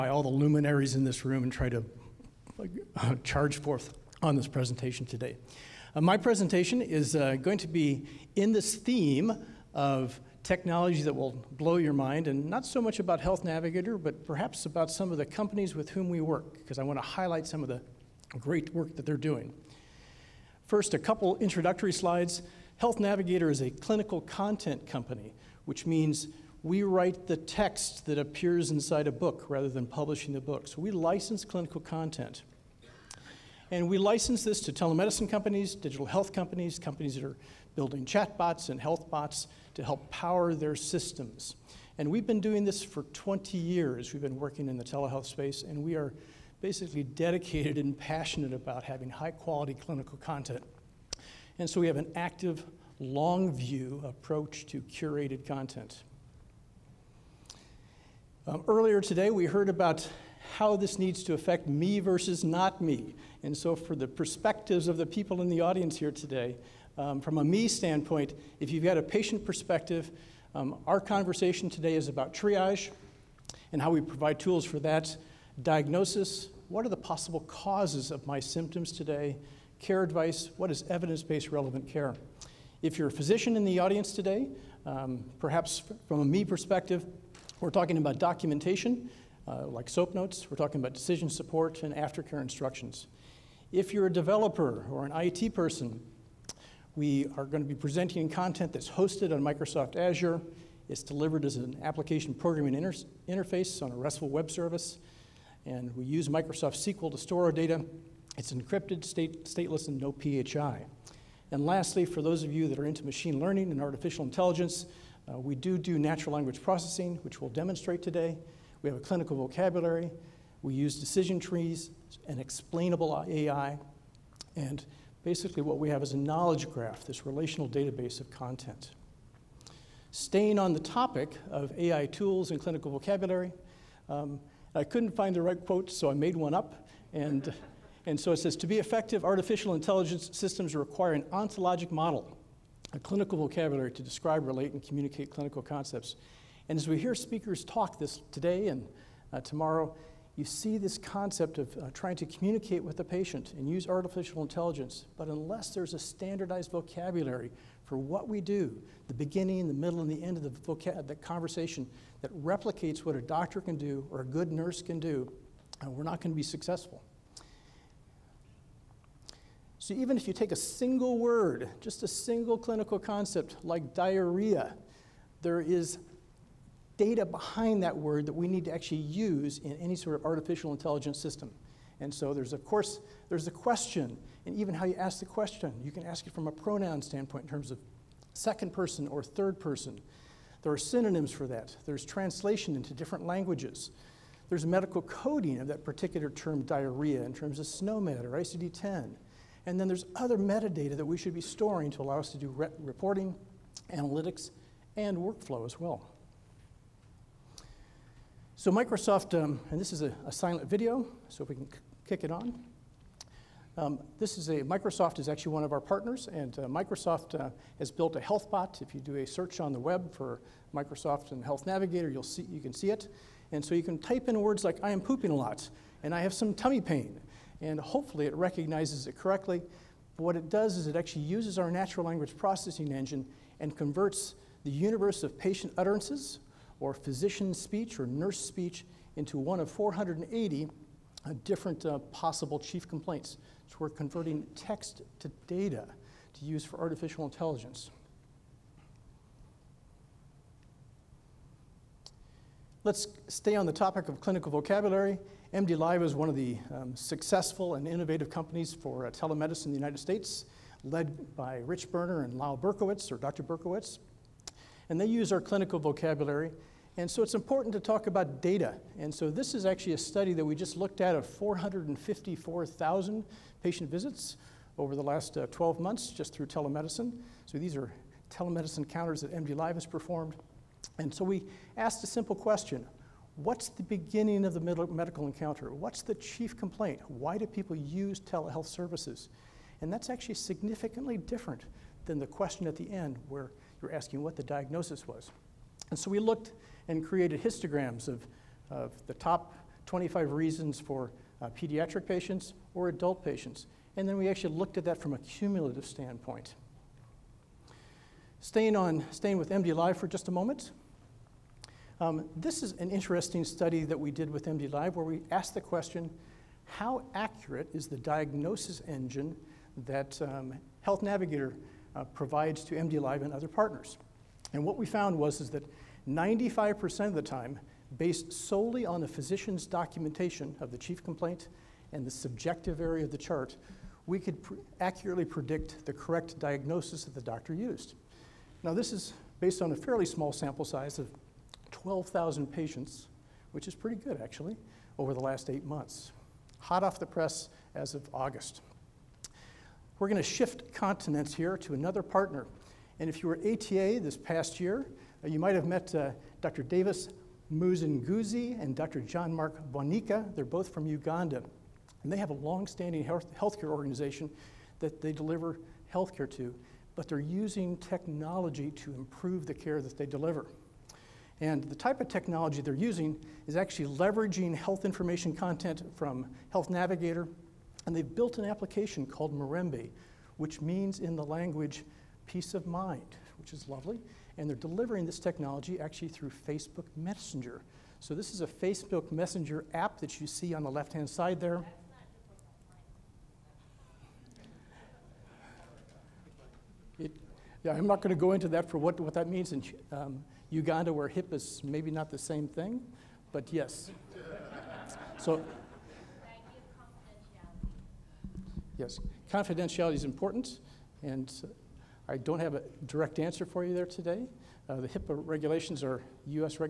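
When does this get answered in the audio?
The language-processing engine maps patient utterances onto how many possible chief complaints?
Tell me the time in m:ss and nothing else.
3:59.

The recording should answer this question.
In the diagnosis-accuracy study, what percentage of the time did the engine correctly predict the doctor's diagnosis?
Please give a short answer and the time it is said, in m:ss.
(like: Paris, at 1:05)
95%, at 5:26.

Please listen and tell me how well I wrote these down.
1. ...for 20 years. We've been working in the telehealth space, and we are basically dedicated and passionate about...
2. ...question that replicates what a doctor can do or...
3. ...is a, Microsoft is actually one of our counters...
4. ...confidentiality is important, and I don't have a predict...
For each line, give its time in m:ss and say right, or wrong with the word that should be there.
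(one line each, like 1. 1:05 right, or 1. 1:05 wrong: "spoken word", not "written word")
1. 0:42 right
2. 2:41 wrong: "conversation", not "question"
3. 3:34 wrong: "partners", not "counters"
4. 6:49 wrong: "direct", not "predict".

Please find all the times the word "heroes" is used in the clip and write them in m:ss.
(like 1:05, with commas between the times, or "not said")
not said.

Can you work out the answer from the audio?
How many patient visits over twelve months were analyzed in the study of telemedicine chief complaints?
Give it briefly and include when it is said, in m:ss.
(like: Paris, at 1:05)
454,000, at 4:31.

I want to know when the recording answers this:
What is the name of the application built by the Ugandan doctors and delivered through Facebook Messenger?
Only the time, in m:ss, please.
6:19.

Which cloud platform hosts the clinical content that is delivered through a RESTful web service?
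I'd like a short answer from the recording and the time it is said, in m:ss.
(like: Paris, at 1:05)
Microsoft Azure, at 1:39.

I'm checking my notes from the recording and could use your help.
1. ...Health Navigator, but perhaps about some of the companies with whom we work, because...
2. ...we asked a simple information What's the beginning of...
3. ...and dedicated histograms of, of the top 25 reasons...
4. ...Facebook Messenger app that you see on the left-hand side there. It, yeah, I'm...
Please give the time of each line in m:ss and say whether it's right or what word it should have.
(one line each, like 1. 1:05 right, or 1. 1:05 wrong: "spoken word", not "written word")
1. 0:13 right
2. 4:41 wrong: "question", not "information"
3. 4:56 wrong: "created", not "dedicated"
4. 6:28 right.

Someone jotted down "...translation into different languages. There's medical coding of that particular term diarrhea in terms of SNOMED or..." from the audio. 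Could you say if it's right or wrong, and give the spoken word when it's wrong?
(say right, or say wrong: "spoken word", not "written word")
right.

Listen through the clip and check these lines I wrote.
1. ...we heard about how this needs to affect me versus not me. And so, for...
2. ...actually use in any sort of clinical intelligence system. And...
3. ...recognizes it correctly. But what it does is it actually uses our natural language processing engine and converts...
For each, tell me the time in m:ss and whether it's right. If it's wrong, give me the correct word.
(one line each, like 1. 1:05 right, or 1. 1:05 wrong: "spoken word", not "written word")
1. 0:59 right
2. 2:58 wrong: "artificial", not "clinical"
3. 3:48 right.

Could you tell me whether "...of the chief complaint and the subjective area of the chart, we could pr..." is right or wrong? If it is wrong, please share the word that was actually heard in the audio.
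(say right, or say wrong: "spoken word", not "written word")
right.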